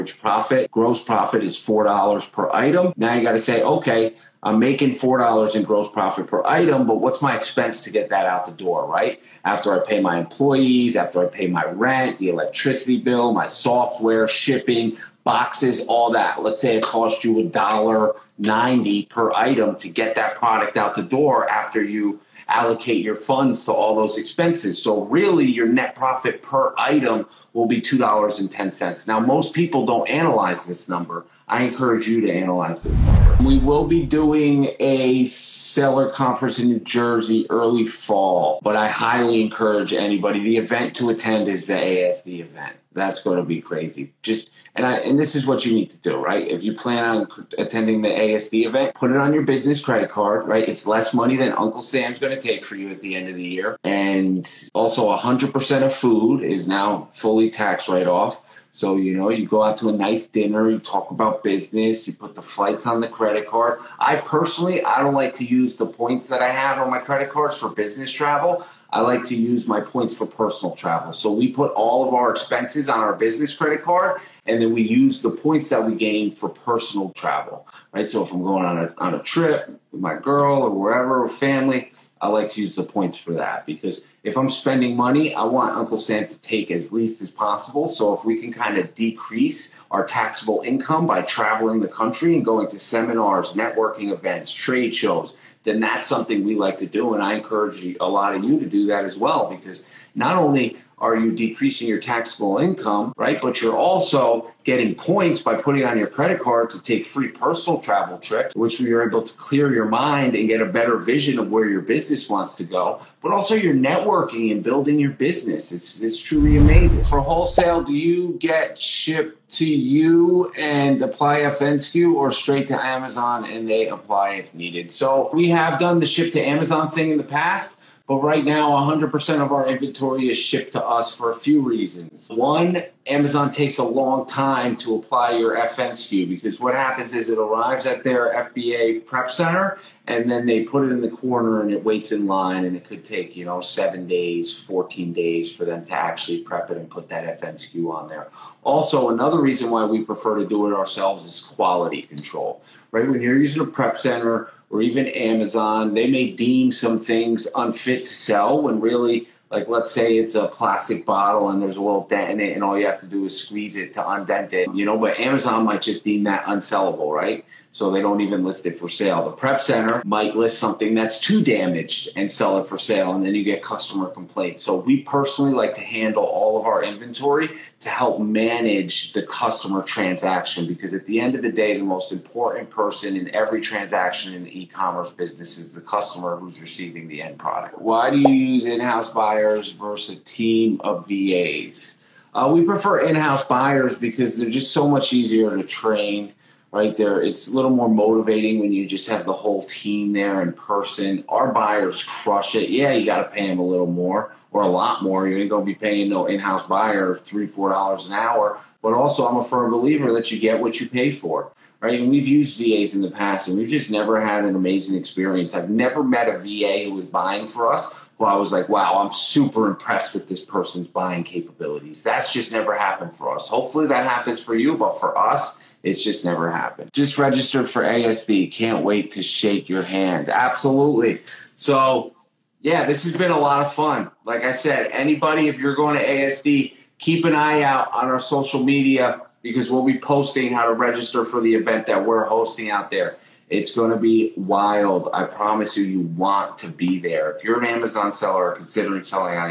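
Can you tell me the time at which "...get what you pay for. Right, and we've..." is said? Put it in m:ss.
3:30.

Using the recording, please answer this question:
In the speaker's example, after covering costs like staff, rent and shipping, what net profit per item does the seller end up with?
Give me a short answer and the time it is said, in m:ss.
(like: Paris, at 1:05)
$2.10, at 0:27.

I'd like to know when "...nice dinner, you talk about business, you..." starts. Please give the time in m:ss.
0:59.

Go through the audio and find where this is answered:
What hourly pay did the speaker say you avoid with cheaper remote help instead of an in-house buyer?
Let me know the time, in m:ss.
3:27.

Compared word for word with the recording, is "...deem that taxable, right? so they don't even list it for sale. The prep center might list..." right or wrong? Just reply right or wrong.
wrong.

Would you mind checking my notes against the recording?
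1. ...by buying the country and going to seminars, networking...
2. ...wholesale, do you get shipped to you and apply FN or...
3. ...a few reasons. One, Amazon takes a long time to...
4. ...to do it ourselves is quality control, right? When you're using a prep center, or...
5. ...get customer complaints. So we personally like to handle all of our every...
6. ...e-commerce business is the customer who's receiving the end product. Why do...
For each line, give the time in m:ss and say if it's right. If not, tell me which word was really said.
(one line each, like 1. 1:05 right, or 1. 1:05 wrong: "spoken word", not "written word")
1. 1:31 wrong: "traveling", not "buying"
2. 1:57 right
3. 2:11 right
4. 2:30 right
5. 2:53 wrong: "inventory", not "every"
6. 3:04 right.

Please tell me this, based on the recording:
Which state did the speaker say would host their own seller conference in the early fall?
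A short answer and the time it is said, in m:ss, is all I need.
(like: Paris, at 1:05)
New Jersey, at 0:36.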